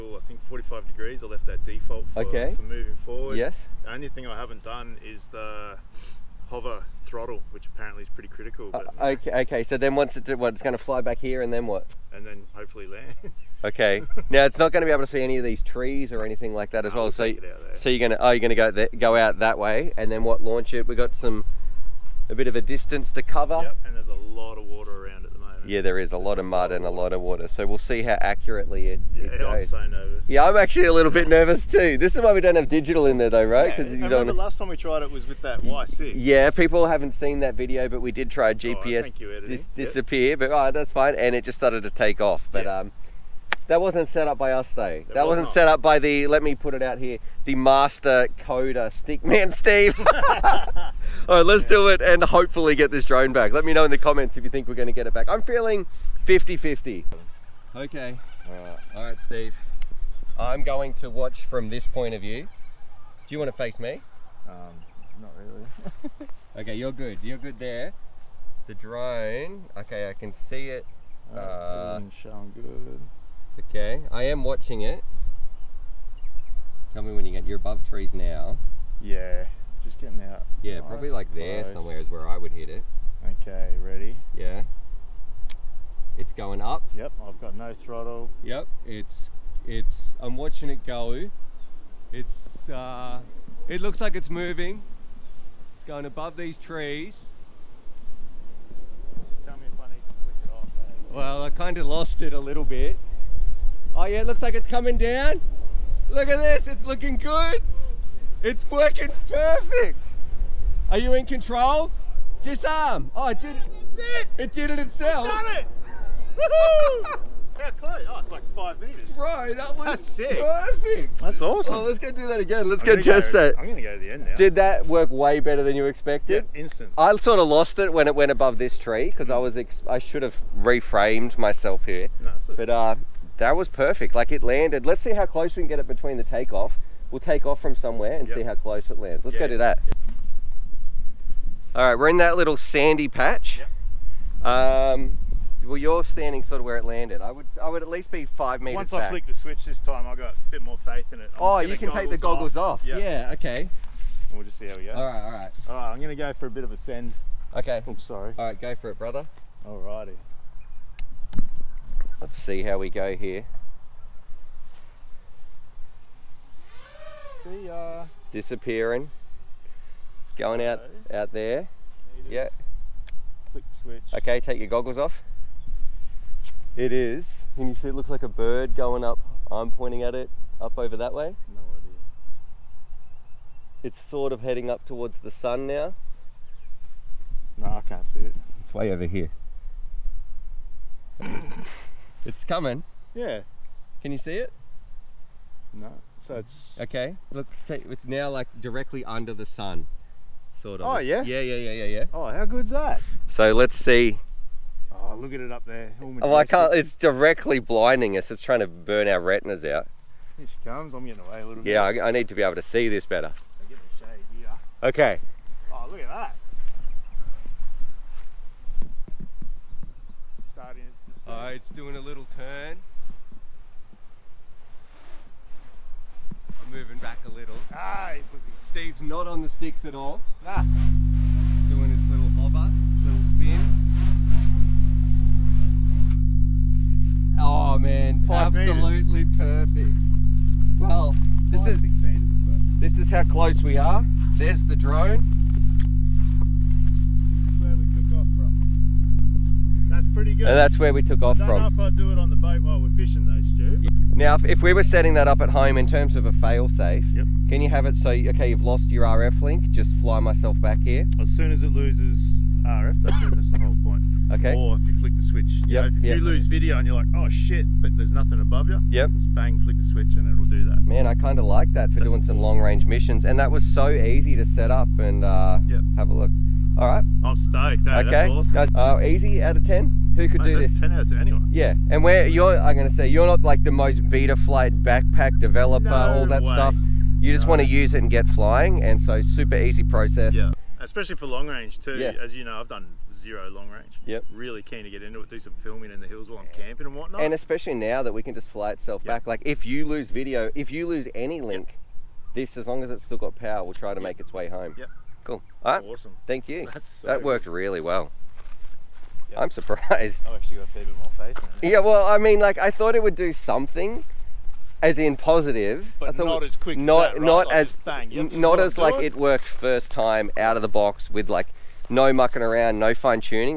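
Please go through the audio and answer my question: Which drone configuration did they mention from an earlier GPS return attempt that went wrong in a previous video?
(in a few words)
Y6.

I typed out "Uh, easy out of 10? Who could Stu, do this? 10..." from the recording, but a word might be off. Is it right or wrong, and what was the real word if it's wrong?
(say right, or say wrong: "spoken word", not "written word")
wrong: "Mate", not "Stu".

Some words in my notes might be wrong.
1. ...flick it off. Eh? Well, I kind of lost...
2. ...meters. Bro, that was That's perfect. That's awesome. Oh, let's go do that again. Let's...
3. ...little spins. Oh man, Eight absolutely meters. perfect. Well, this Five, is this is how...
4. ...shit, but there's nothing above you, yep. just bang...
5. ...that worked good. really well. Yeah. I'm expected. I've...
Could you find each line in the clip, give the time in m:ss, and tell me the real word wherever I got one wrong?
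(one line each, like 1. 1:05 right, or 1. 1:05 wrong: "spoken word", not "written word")
1. 1:40 right
2. 1:58 right
3. 3:53 wrong: "Five", not "Eight"
4. 4:27 right
5. 5:07 wrong: "surprised", not "expected".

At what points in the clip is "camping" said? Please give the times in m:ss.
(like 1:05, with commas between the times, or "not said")
4:56.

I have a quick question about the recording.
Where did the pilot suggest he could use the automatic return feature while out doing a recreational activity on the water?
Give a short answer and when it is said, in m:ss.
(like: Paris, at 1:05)
On the boat, at 4:12.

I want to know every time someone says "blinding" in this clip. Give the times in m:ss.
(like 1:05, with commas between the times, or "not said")
3:27.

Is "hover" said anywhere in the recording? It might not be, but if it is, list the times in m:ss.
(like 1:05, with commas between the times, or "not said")
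0:06, 3:52.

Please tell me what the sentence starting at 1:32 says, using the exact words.
It's, uh, it looks like it's moving.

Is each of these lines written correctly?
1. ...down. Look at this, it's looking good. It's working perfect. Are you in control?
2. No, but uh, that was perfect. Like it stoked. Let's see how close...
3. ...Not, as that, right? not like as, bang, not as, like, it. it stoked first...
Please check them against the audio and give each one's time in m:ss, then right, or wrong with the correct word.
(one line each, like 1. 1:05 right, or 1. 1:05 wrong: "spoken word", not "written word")
1. 1:44 right
2. 2:12 wrong: "landed", not "stoked"
3. 5:16 wrong: "worked", not "stoked".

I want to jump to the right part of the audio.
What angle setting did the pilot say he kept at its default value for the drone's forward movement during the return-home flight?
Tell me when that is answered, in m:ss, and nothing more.
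0:00.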